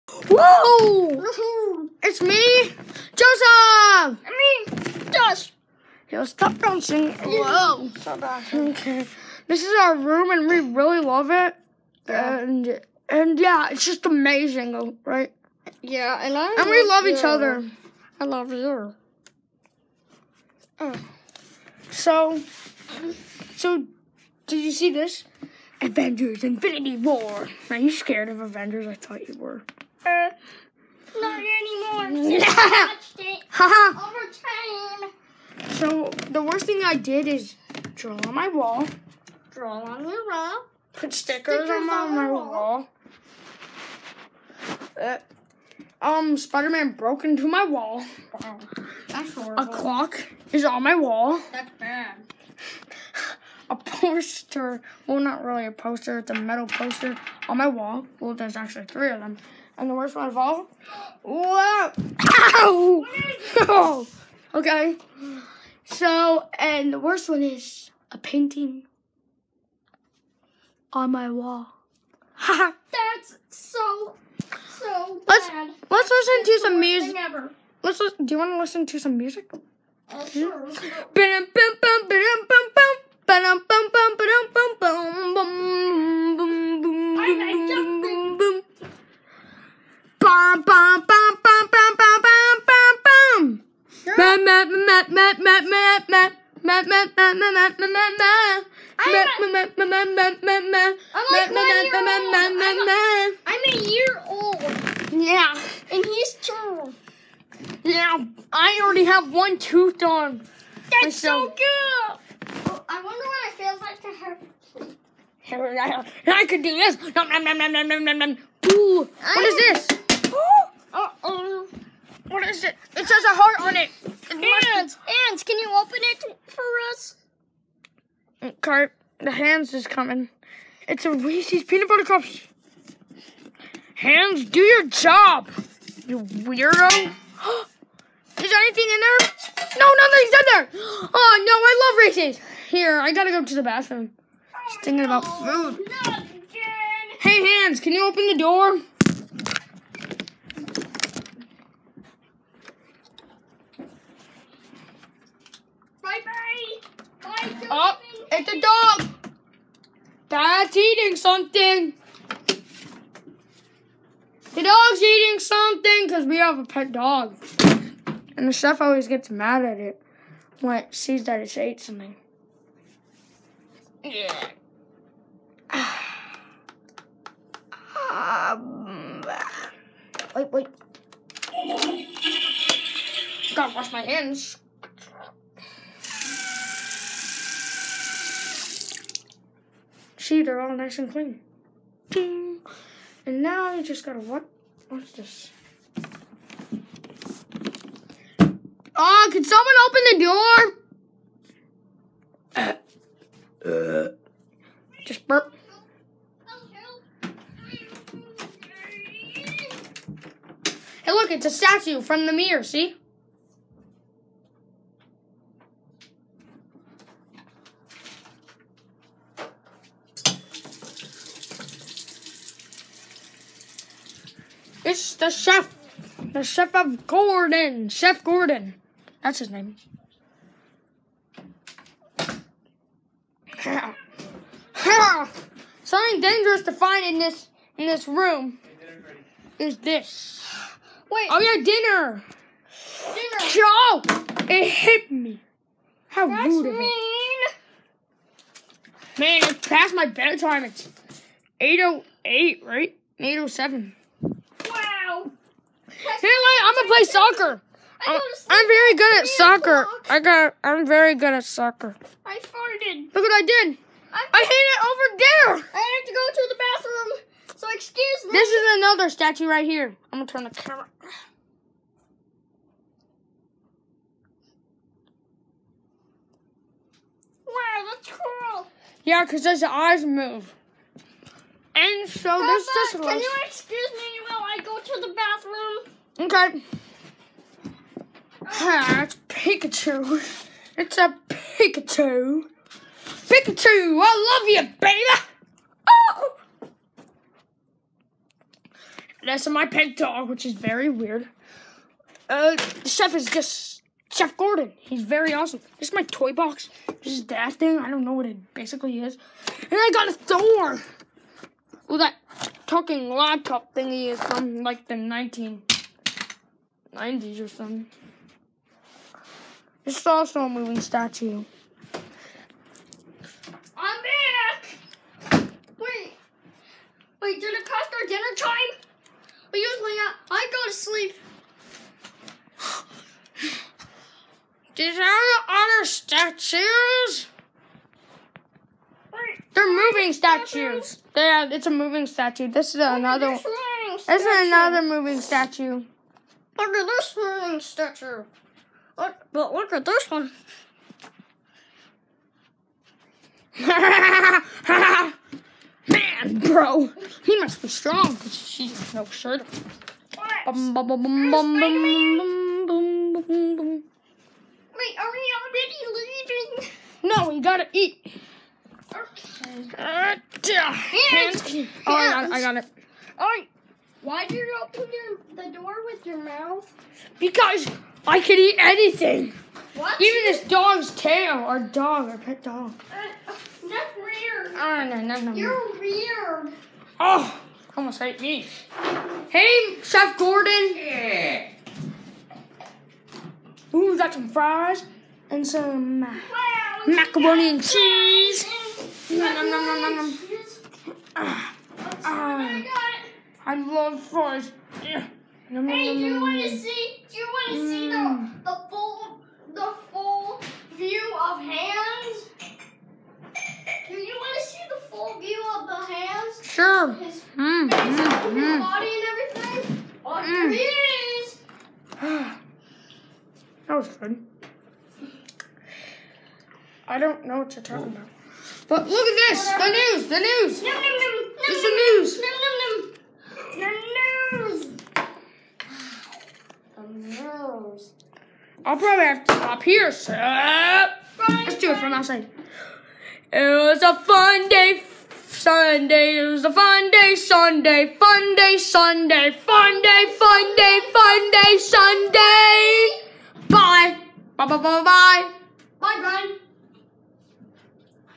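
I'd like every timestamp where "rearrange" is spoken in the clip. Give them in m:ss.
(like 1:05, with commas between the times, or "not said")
not said.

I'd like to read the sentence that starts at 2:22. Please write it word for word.
Here, I gotta go to the bathroom.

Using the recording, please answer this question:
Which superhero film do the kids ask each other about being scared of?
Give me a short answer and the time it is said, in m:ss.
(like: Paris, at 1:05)
Avengers Infinity War, at 0:25.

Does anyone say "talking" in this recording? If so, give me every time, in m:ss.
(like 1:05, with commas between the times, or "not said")
5:12, 7:07.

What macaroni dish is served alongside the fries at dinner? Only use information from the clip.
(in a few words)
Macaroni and cheese.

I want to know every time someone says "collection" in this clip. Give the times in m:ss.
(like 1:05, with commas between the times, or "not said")
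not said.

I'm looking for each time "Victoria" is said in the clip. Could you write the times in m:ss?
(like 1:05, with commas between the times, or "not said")
not said.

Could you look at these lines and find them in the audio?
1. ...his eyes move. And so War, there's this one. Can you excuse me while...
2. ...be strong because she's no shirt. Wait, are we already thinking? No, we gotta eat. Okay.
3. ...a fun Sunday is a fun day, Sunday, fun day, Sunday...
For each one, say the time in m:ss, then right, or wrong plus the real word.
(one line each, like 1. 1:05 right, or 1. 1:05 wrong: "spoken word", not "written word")
1. 4:39 wrong: "Papa", not "War"
2. 5:57 wrong: "leaving", not "thinking"
3. 7:23 right.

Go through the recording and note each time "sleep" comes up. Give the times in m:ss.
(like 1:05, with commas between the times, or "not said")
5:30.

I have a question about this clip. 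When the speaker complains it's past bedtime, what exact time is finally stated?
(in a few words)
8:07.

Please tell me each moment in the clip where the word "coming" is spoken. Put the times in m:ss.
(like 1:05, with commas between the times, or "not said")
2:09.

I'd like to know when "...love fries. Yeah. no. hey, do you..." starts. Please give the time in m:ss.
6:43.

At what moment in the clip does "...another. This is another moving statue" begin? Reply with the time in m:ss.
5:42.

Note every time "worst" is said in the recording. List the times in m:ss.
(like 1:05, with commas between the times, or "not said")
0:36, 0:59, 1:06.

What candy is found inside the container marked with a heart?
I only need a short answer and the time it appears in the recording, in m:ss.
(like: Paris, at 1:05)
Reese's peanut butter cups, at 2:11.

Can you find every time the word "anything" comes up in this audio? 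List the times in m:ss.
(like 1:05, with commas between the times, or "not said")
2:18, 6:18.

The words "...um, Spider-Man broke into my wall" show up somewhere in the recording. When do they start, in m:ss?
0:46.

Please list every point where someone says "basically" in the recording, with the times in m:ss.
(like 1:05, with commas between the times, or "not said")
5:08.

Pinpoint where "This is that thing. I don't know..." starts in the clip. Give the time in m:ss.
5:07.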